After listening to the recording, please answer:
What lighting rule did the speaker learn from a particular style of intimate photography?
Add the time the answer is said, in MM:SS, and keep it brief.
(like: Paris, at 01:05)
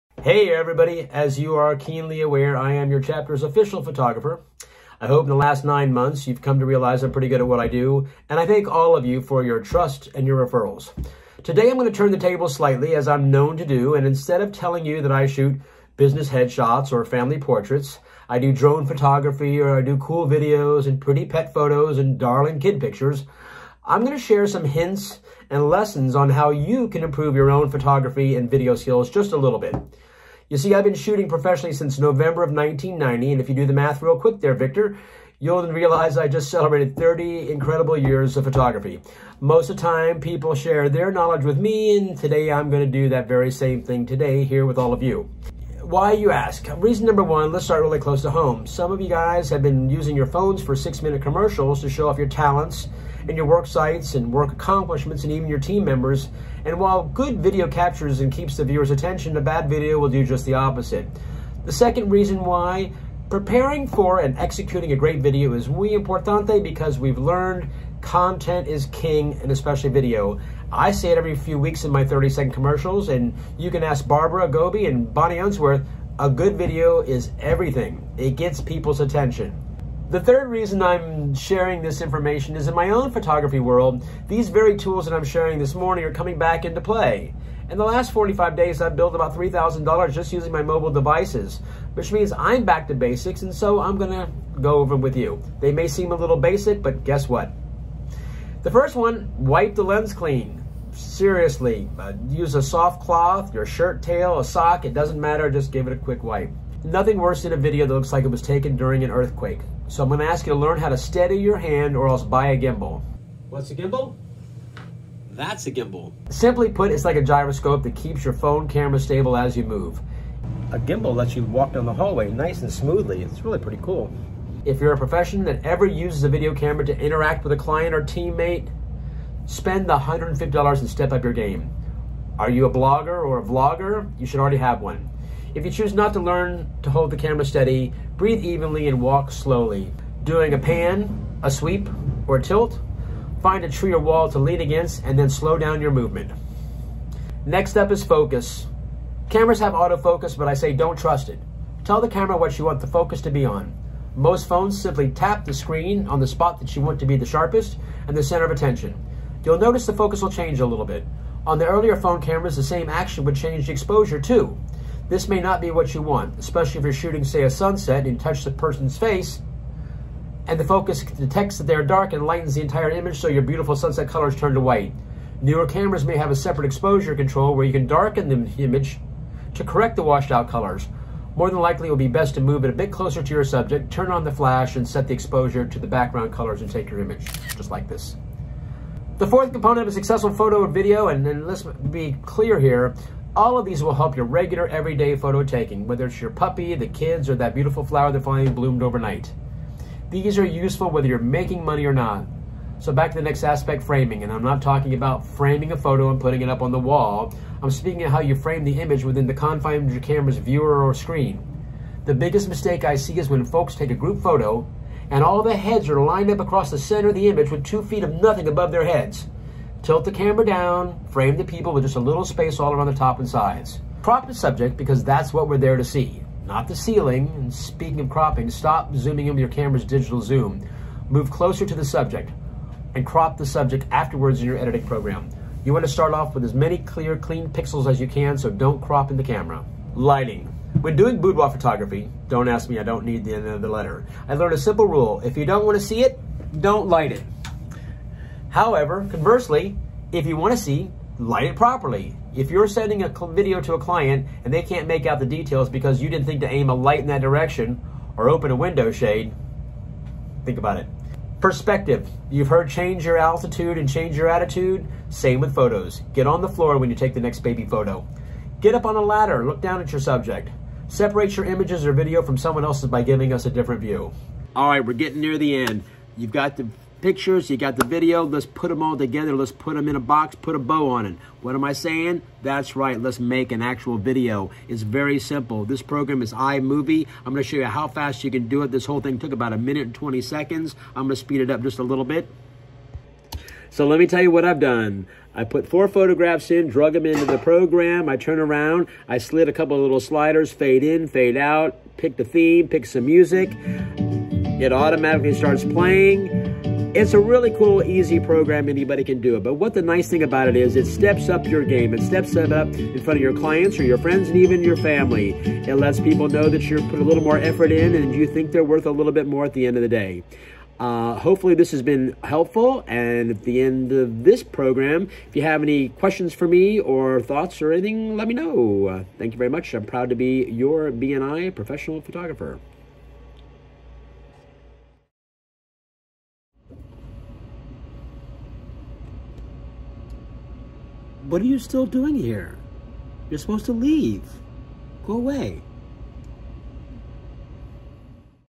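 If you don't want to see it, don't light it, at 04:05.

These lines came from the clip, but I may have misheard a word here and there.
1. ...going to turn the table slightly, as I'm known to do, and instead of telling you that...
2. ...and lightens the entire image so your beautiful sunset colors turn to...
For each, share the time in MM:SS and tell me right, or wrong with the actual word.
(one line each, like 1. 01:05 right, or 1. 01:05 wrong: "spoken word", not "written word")
1. 00:11 right
2. 02:52 right.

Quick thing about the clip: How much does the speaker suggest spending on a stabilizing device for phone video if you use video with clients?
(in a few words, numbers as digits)
$150.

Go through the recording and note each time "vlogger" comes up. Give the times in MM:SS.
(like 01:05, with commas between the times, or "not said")
02:13.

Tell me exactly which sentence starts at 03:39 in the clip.
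Tilt the camera down, frame the people with just a little space all around the top and sides.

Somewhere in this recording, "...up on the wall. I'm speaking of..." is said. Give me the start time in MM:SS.
03:26.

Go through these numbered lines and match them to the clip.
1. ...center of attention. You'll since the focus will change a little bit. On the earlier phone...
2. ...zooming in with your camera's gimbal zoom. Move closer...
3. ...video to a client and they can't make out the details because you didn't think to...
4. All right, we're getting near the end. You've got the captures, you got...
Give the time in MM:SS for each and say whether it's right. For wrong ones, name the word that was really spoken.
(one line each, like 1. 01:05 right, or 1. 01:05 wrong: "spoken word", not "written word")
1. 02:38 wrong: "notice", not "since"
2. 03:48 wrong: "digital", not "gimbal"
3. 04:13 right
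4. 04:34 wrong: "pictures", not "captures".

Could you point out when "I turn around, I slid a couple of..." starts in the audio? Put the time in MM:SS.
04:58.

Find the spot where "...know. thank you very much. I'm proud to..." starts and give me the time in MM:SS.
05:28.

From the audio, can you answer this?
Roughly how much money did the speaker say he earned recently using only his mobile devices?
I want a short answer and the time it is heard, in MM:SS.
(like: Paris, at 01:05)
$3,000, at 01:29.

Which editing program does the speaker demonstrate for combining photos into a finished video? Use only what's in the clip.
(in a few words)
iMovie.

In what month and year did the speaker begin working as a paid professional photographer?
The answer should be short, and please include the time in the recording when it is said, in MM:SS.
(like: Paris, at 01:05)
November 1990, at 00:31.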